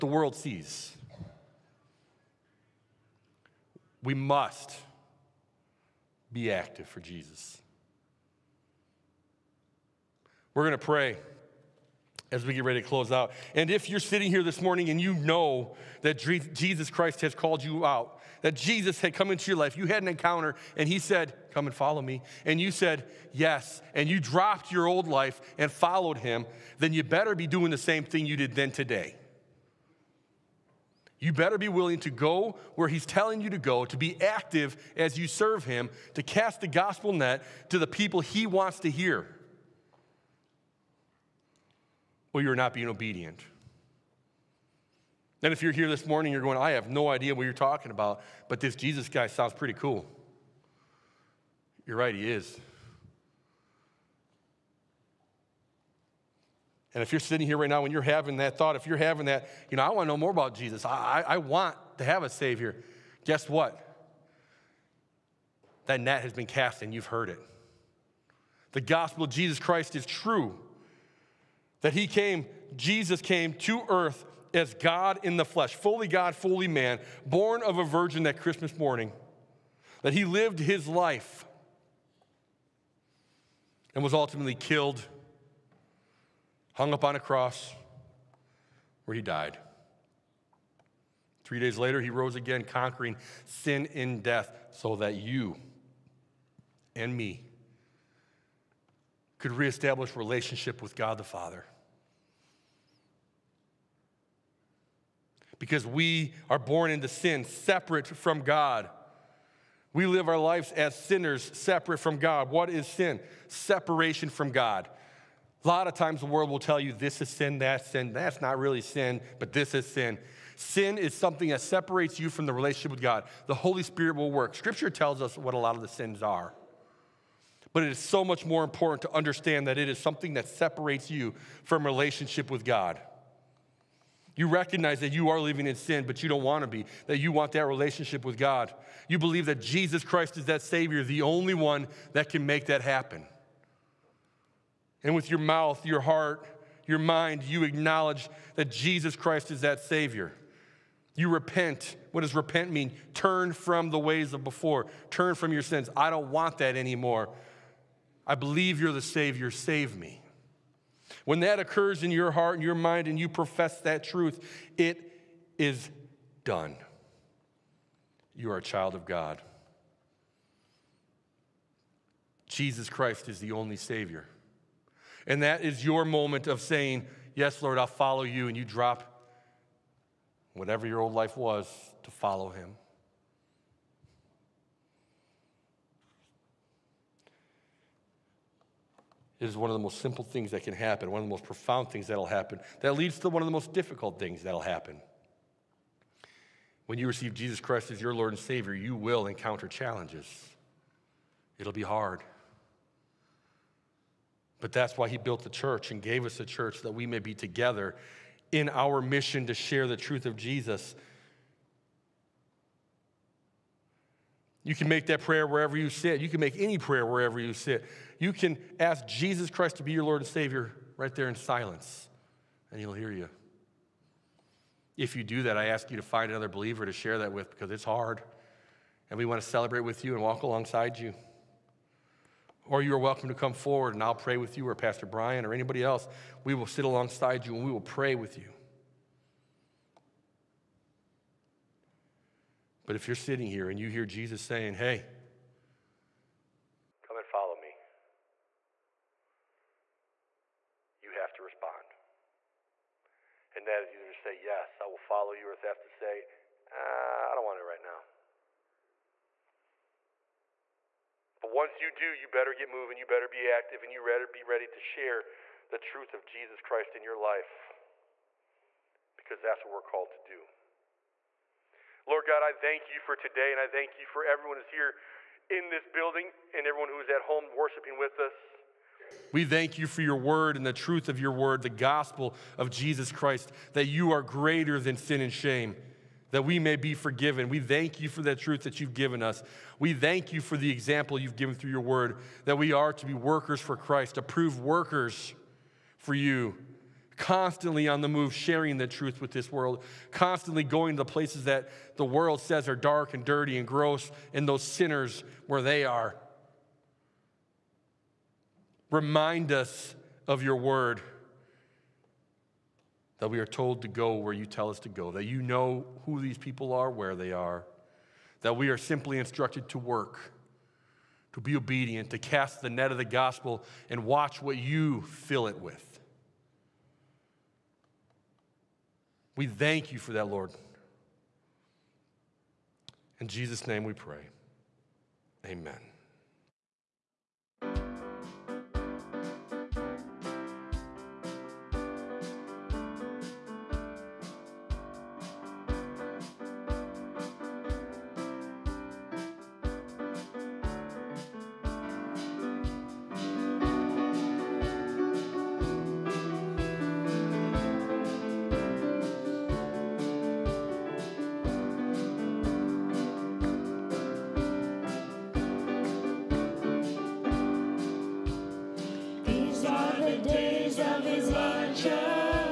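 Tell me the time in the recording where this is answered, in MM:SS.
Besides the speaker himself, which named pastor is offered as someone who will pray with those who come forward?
03:54.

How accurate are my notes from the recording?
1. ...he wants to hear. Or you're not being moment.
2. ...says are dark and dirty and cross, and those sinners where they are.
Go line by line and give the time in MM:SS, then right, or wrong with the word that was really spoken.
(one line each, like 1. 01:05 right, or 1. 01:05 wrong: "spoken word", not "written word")
1. 00:38 wrong: "obedient", not "moment"
2. 05:02 wrong: "gross", not "cross".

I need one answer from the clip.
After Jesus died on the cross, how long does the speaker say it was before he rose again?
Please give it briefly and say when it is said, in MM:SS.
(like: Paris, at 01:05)
3 days, at 01:31.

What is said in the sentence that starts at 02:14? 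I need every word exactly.
You recognize that you are living in sin, but you don't want to be, that you want that relationship with God.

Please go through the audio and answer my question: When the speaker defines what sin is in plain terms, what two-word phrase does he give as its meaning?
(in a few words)
Separation from God.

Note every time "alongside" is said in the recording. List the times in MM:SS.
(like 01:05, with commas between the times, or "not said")
03:50, 03:56.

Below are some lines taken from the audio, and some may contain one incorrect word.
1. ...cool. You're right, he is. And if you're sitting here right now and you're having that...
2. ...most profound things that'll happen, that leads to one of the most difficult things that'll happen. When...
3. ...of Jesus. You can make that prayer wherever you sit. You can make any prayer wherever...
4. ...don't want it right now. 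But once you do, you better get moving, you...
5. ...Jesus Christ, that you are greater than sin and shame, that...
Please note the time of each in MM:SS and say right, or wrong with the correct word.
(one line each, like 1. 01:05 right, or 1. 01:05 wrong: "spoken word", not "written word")
1. 00:49 right
2. 03:11 right
3. 03:30 right
4. 04:17 right
5. 04:42 right.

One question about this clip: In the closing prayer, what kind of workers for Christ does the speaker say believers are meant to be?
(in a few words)
Approved workers.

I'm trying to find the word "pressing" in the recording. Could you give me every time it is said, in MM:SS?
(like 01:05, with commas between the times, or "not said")
not said.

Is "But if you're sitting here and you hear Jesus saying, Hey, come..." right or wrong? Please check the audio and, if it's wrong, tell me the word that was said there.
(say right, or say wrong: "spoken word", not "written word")
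right.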